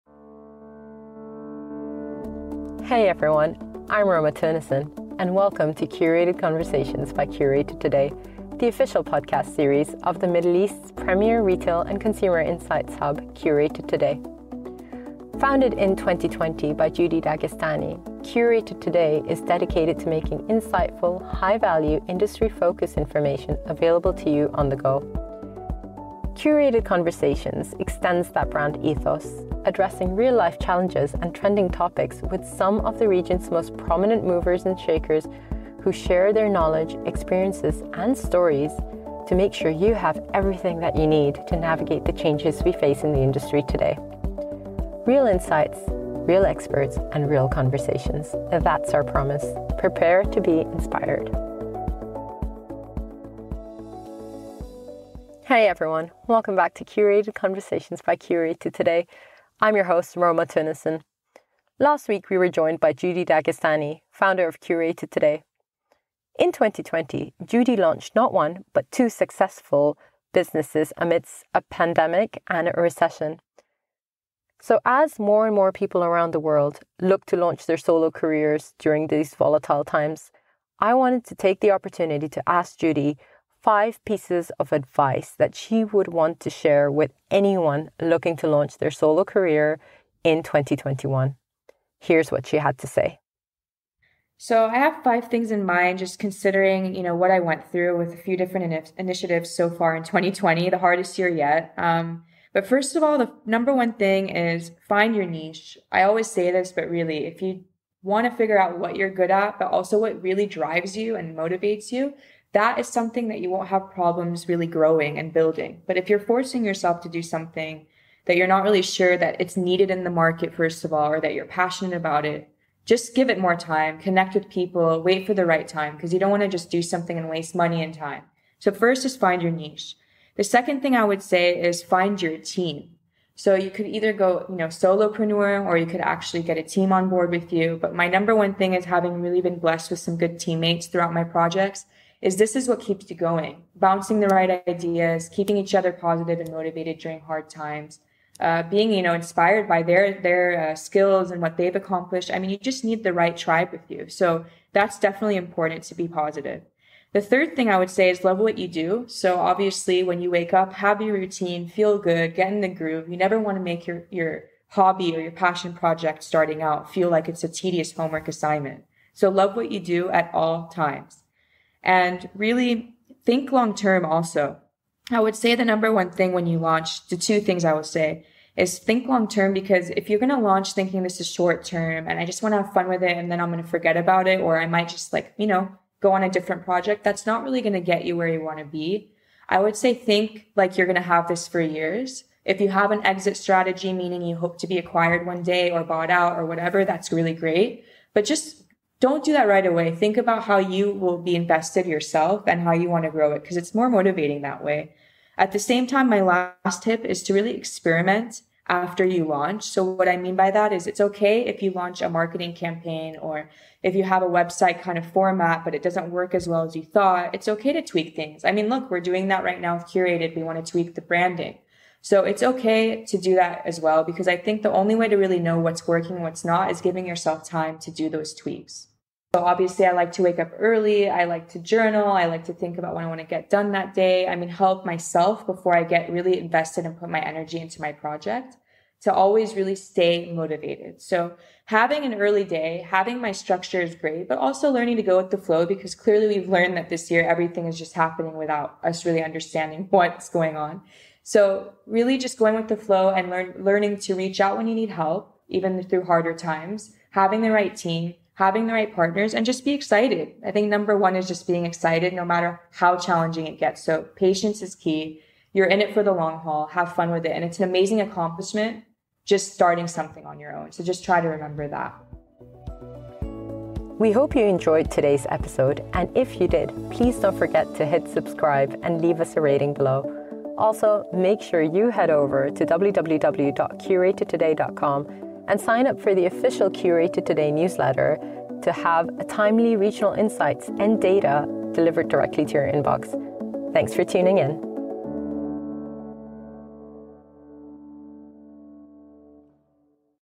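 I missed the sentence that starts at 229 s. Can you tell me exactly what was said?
So obviously I like to wake up early.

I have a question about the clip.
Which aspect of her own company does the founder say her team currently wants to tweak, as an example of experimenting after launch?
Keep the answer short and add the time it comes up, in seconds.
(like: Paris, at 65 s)
The branding, at 220 s.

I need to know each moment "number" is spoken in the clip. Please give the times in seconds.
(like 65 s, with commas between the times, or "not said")
103 s, 138 s, 175 s, 260 s.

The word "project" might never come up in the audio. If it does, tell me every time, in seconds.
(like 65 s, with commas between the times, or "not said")
141 s, 165 s, 186 s, 237 s.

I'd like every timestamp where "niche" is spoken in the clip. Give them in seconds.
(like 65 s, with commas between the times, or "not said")
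105 s, 129 s.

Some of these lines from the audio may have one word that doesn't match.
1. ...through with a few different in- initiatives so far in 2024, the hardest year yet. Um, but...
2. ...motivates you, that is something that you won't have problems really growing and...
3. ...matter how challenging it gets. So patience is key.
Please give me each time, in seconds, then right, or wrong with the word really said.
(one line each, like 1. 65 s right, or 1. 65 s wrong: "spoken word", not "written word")
1. 97 s wrong: "2020", not "2024"
2. 111 s right
3. 262 s right.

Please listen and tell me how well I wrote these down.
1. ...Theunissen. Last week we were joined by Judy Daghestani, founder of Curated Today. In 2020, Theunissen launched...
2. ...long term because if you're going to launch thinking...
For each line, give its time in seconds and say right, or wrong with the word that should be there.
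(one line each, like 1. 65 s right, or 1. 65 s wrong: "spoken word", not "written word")
1. 60 s wrong: "Judy", not "Theunissen"
2. 179 s right.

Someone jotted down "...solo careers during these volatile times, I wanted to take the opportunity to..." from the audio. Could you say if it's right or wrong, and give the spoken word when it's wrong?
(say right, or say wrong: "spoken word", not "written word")
right.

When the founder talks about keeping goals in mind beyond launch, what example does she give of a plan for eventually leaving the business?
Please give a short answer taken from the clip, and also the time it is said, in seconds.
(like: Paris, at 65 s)
Exit strategy, at 193 s.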